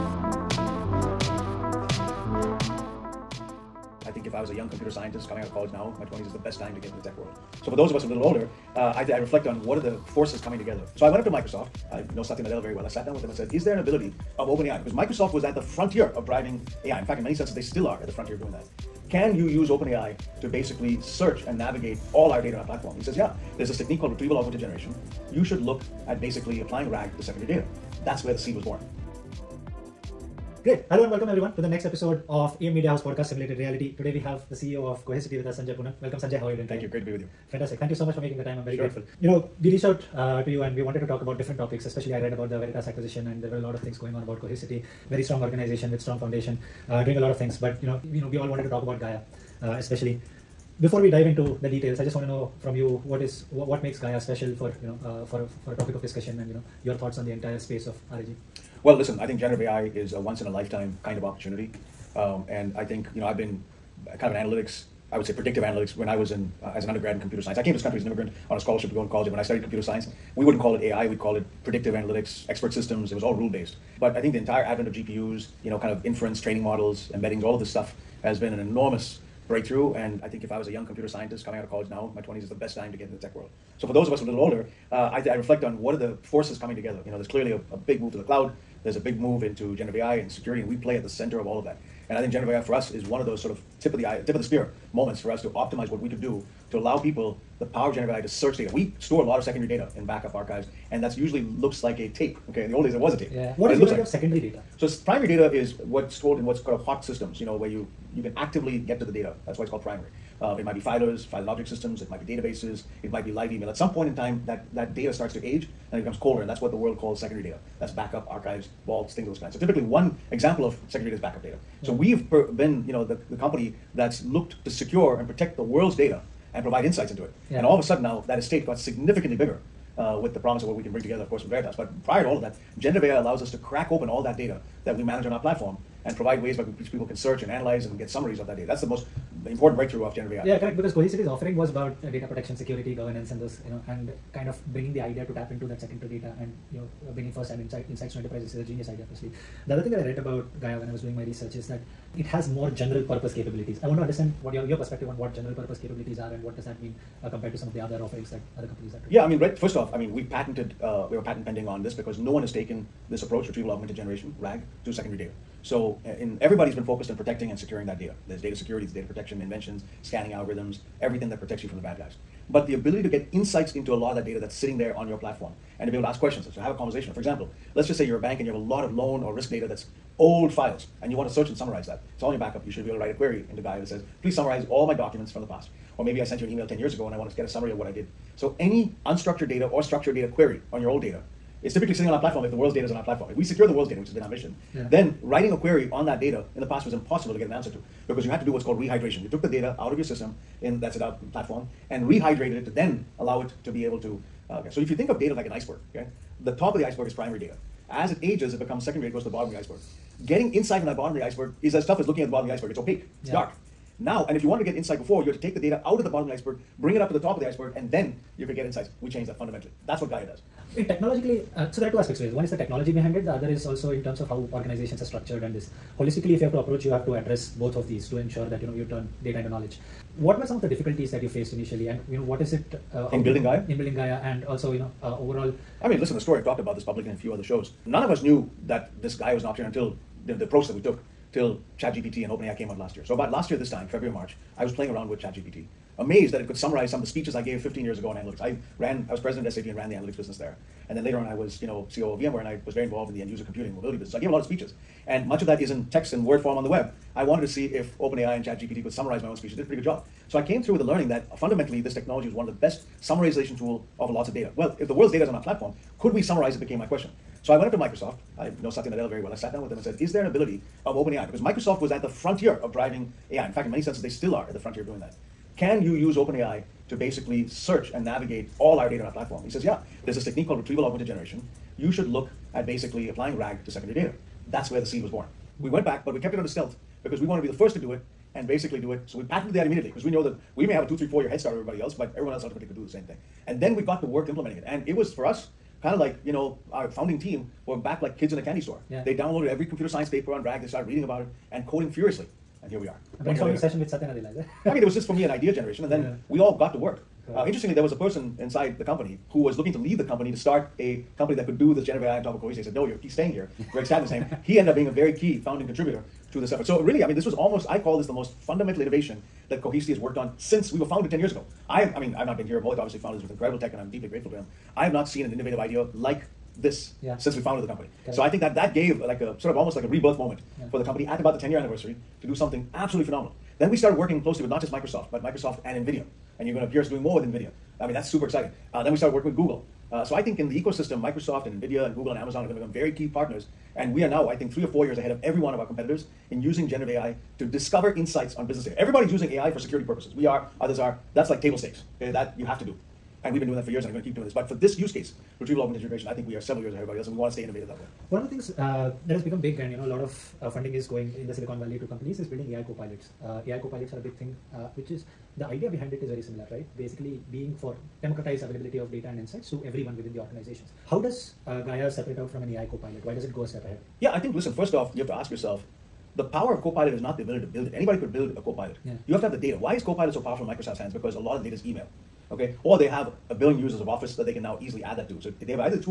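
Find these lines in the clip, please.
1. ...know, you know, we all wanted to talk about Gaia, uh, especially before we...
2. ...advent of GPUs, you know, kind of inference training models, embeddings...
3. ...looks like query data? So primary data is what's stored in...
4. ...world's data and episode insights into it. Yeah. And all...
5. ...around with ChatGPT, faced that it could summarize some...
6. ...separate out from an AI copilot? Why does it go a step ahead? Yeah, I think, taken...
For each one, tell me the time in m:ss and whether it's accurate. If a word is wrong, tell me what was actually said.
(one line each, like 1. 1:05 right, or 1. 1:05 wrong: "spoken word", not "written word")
1. 0:47 right
2. 1:14 right
3. 1:43 wrong: "secondary", not "query"
4. 2:05 wrong: "provide", not "episode"
5. 4:04 wrong: "amazed", not "faced"
6. 6:11 wrong: "listen", not "taken".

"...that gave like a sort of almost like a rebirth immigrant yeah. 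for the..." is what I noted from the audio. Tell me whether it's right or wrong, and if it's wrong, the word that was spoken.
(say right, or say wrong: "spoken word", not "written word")
wrong: "moment", not "immigrant".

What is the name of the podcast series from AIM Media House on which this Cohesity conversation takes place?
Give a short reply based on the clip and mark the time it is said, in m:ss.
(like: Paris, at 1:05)
Simulated Reality, at 0:33.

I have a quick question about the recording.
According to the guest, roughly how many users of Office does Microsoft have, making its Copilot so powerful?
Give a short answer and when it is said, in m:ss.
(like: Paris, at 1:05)
1 billion, at 6:23.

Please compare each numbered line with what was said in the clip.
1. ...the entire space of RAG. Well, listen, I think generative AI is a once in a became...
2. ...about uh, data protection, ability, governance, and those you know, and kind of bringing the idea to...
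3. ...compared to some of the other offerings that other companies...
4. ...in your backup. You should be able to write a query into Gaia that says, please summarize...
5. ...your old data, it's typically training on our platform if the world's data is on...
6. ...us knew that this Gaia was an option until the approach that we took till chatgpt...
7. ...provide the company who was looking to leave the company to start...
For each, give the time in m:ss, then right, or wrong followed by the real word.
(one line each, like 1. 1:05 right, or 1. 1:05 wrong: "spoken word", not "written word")
1. 0:57 wrong: "lifetime", not "became"
2. 2:21 wrong: "security", not "ability"
3. 2:37 right
4. 3:02 right
5. 3:10 wrong: "sitting", not "training"
6. 3:58 right
7. 5:08 wrong: "inside", not "provide".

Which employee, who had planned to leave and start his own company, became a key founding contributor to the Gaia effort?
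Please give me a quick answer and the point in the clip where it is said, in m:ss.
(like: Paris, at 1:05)
Greg Statman, at 5:13.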